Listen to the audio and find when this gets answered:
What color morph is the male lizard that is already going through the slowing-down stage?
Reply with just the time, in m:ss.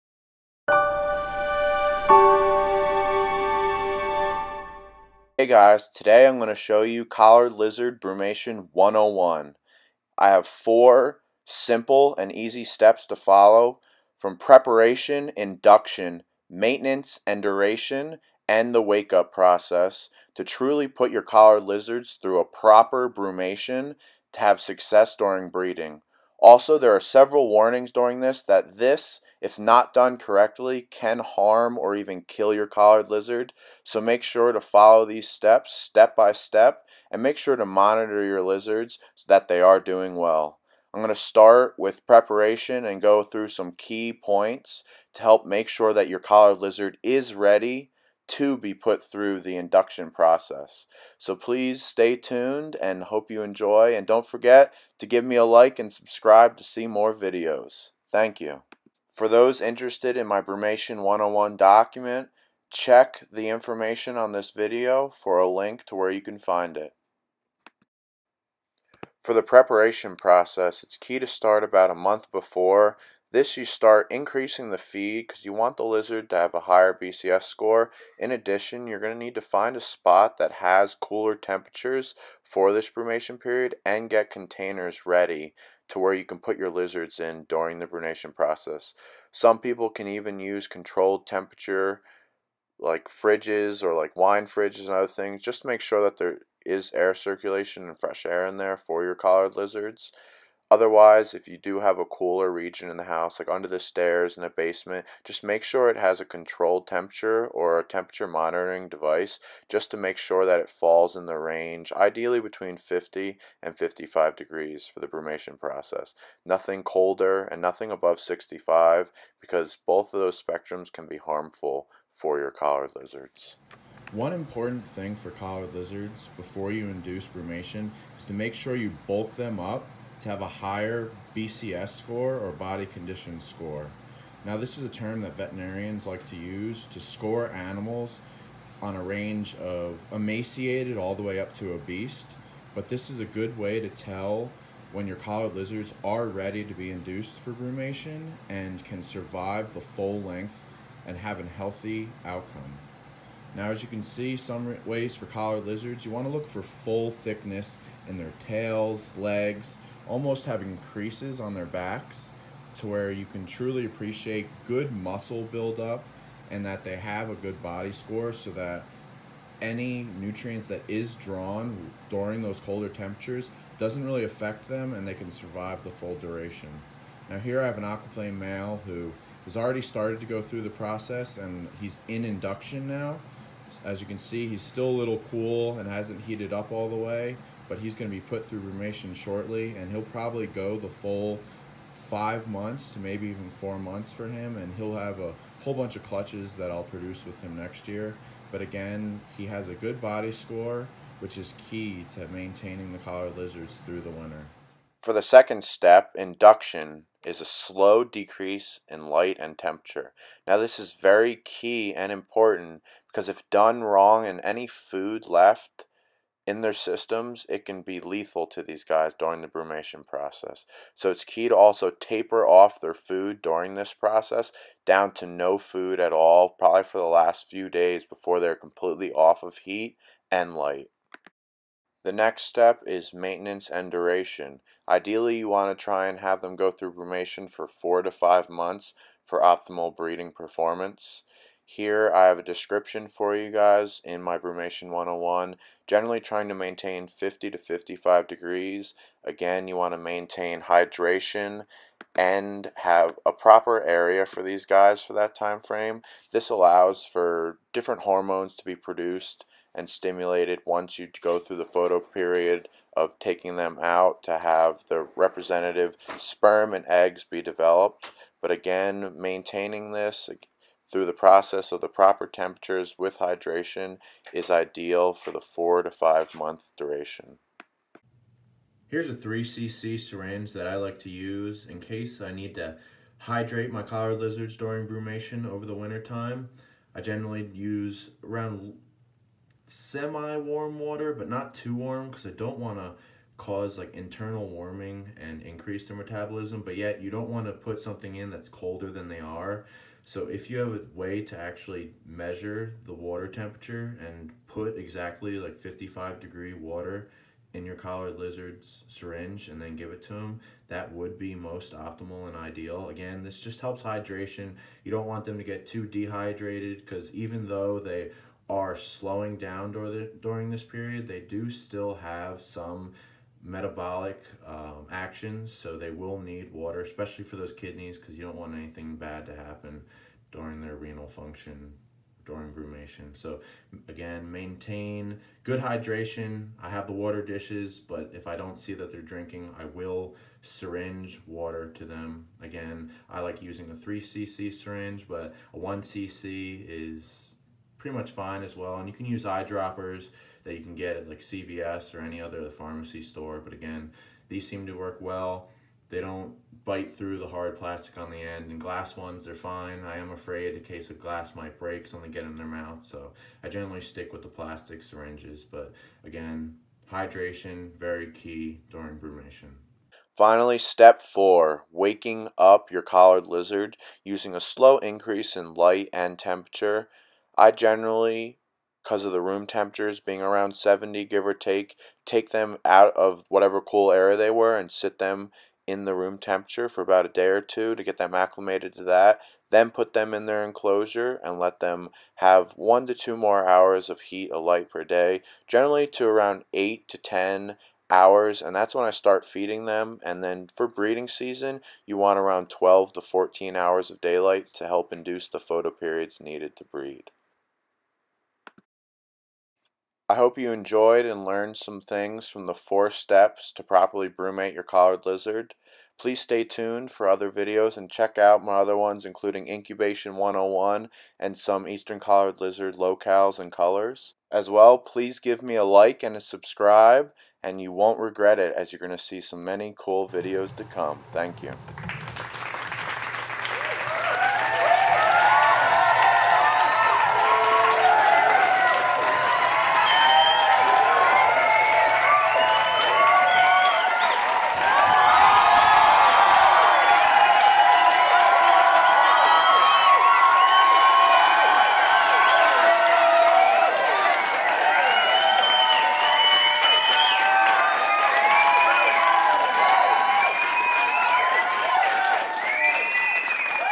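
2:57.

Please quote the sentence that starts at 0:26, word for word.
Also, there are several warnings during this that this, if not done correctly, can harm or even kill your collared lizard.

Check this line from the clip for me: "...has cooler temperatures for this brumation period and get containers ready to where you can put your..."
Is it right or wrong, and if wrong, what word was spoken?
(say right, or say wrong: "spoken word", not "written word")
right.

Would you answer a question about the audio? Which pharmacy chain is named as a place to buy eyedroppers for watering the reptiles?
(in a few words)
CVS.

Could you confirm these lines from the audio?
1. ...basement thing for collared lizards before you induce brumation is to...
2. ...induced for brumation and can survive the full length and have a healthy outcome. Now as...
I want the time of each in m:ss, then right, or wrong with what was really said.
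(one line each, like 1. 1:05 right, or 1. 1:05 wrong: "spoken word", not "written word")
1. 2:04 wrong: "important", not "basement"
2. 2:26 right.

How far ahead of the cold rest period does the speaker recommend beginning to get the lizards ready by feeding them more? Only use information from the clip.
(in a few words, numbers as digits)
a month.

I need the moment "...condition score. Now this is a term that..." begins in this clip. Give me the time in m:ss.
2:12.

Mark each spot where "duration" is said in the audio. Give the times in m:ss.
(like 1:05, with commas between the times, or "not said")
0:17, 2:56, 3:53, 4:36.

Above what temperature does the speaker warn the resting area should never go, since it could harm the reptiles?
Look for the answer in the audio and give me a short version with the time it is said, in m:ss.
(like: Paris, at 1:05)
65, at 1:57.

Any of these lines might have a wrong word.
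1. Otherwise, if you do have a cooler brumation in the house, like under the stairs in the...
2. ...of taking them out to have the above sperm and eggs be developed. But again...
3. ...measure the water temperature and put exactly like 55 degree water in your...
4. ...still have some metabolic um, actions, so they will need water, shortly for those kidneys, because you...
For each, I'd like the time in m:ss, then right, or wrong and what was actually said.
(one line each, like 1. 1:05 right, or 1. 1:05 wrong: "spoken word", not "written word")
1. 1:40 wrong: "region", not "brumation"
2. 4:22 wrong: "representative", not "above"
3. 5:02 right
4. 5:21 wrong: "especially", not "shortly".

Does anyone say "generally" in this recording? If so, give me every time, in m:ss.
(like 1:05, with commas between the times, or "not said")
4:05, 4:46, 6:03, 6:17, 6:35.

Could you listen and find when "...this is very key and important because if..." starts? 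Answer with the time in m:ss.
3:30.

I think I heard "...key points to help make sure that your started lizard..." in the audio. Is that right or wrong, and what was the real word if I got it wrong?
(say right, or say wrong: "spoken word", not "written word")
wrong: "collared", not "started".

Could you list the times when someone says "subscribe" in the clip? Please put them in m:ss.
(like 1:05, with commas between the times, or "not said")
0:55, 7:06.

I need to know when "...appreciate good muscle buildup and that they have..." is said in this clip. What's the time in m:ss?
2:43.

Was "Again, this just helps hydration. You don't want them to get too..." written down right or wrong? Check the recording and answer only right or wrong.
right.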